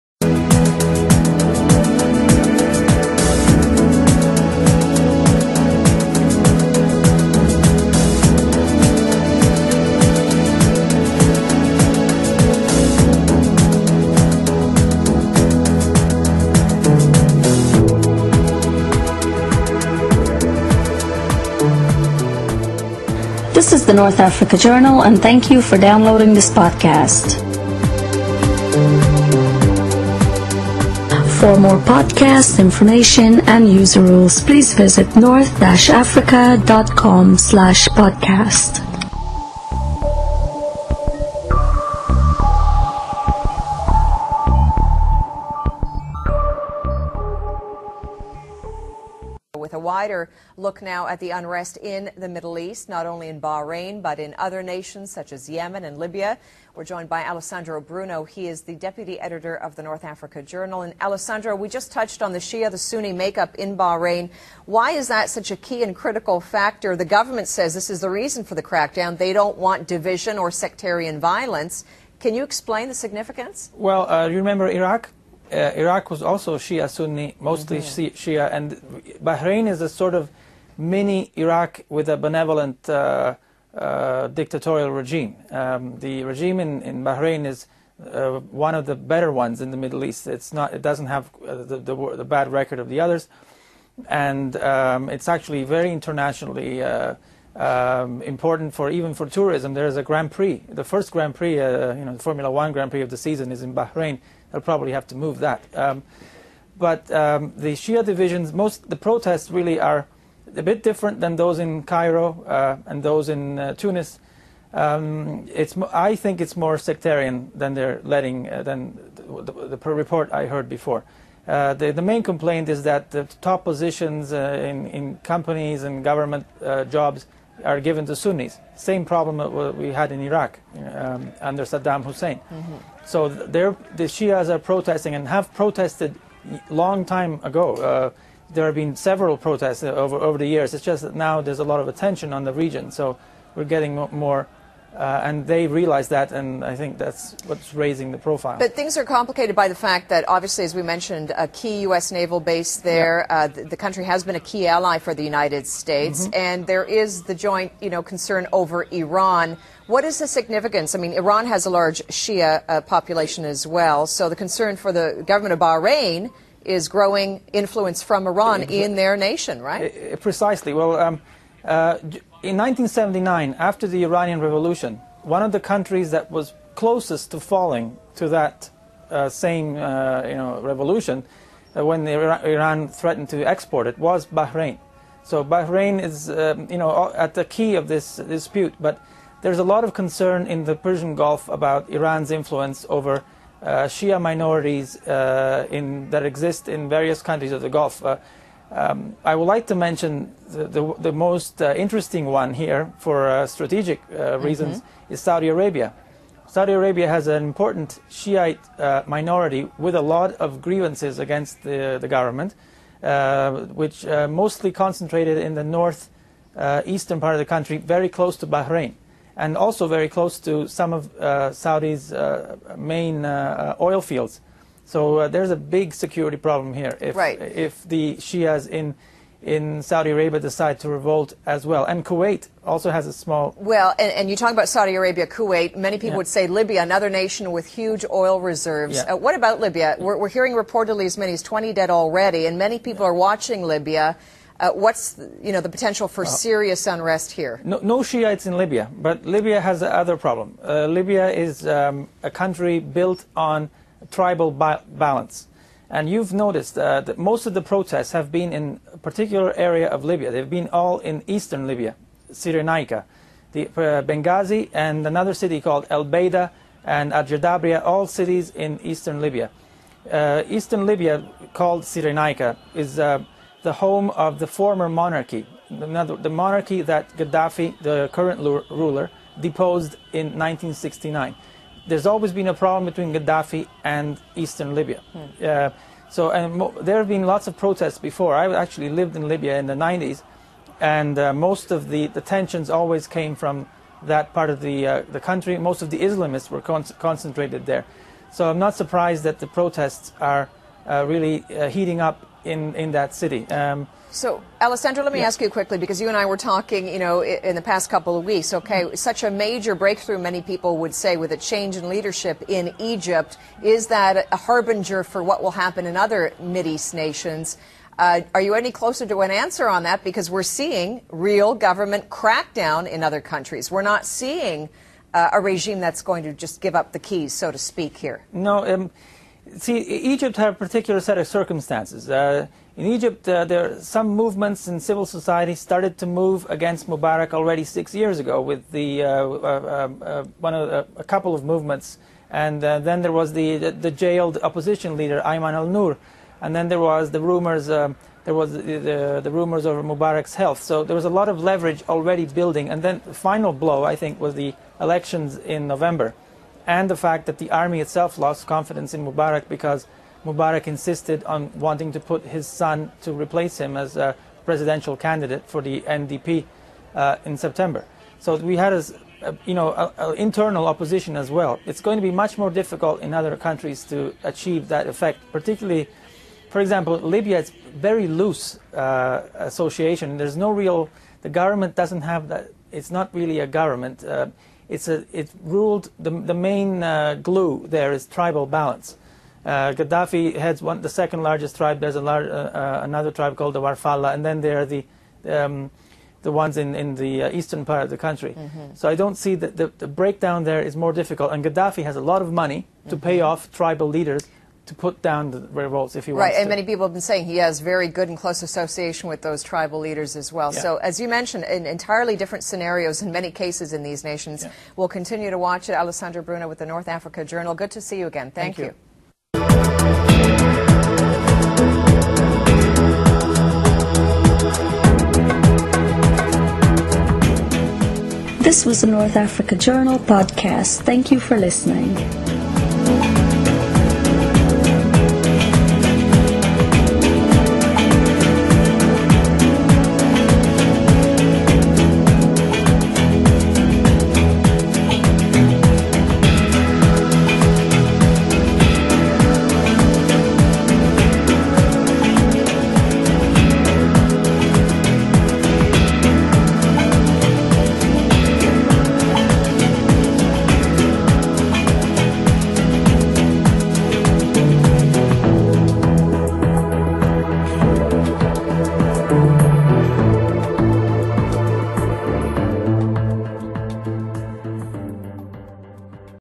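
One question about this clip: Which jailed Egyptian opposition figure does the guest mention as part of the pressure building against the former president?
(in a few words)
Ayman al Nur.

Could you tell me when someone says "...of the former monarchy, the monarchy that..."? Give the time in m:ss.
4:34.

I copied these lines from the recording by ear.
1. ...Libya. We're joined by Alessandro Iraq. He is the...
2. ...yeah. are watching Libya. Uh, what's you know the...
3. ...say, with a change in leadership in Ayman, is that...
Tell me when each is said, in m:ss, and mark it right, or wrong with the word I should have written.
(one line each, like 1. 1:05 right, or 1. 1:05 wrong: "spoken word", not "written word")
1. 0:55 wrong: "Bruno", not "Iraq"
2. 4:03 right
3. 5:10 wrong: "Egypt", not "Ayman".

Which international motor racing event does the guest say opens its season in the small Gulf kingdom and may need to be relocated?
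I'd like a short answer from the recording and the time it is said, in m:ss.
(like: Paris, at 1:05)
Formula One Grand Prix, at 1:42.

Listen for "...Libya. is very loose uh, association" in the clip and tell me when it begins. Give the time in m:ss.
6:16.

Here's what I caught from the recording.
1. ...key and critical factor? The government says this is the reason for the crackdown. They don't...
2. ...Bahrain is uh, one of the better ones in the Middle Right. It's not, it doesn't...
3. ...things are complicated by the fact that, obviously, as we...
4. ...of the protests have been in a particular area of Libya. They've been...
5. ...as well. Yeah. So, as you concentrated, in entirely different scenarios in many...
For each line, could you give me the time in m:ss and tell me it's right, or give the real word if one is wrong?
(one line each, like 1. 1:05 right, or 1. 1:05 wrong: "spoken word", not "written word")
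1. 1:05 right
2. 1:27 wrong: "East", not "Right"
3. 2:28 right
4. 4:17 right
5. 6:50 wrong: "mentioned", not "concentrated".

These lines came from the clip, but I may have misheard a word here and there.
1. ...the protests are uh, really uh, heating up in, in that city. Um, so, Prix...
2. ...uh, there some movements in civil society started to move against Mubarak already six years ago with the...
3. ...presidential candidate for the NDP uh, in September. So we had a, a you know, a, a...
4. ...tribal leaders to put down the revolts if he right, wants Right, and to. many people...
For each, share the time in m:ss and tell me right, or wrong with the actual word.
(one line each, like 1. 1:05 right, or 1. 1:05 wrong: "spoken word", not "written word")
1. 4:59 wrong: "Alessandro", not "Prix"
2. 5:33 right
3. 6:04 right
4. 6:43 right.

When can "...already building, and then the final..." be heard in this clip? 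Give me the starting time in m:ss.
5:51.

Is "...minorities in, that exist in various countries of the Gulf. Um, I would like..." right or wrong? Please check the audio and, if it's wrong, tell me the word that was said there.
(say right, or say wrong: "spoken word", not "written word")
right.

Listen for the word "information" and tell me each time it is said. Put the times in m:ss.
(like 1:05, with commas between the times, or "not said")
0:32.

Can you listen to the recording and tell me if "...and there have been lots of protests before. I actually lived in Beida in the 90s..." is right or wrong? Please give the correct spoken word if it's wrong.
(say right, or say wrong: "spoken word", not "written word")
wrong: "Libya", not "Beida".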